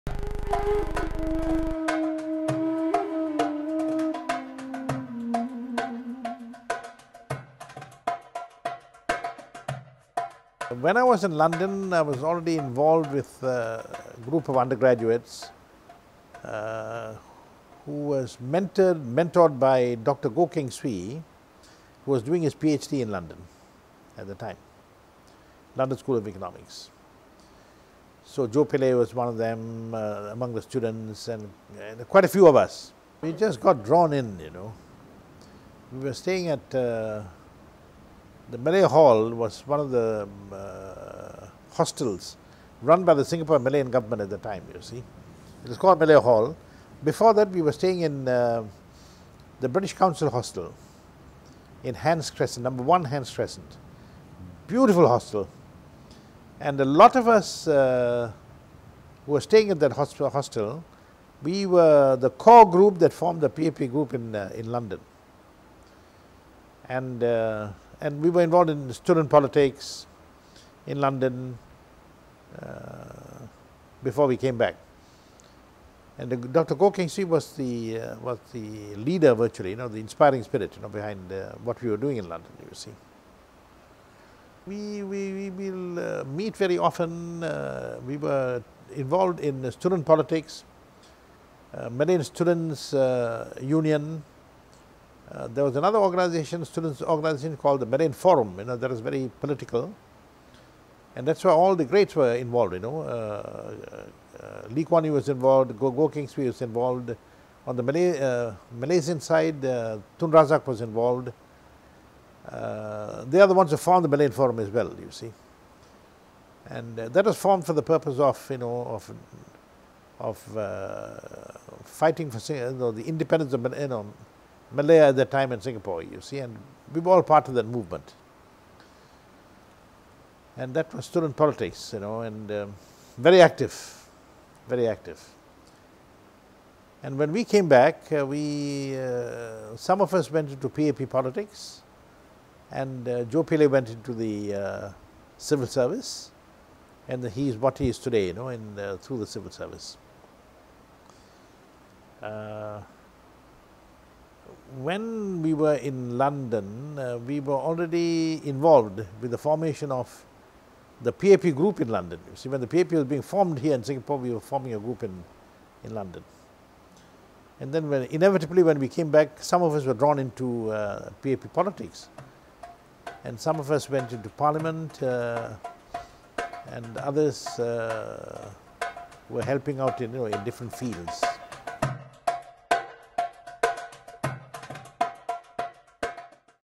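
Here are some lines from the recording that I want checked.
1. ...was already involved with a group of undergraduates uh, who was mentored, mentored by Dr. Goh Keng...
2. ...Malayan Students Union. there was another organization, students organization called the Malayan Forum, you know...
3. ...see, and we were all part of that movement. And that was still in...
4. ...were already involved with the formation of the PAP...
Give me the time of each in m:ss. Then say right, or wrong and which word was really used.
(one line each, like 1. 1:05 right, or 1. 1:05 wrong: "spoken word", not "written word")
1. 0:12 right
2. 1:31 right
3. 2:06 right
4. 2:37 right.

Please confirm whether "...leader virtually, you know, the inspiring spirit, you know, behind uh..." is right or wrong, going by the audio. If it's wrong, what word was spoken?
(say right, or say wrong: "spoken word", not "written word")
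right.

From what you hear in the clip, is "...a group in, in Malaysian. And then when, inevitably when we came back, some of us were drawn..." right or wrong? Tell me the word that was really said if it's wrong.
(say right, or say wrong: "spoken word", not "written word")
wrong: "London", not "Malaysian".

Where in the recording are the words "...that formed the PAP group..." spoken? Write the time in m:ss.
1:02.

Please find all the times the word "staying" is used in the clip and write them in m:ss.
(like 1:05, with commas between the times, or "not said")
0:36, 0:47, 0:59.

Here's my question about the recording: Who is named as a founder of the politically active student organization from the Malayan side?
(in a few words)
Tun Razak.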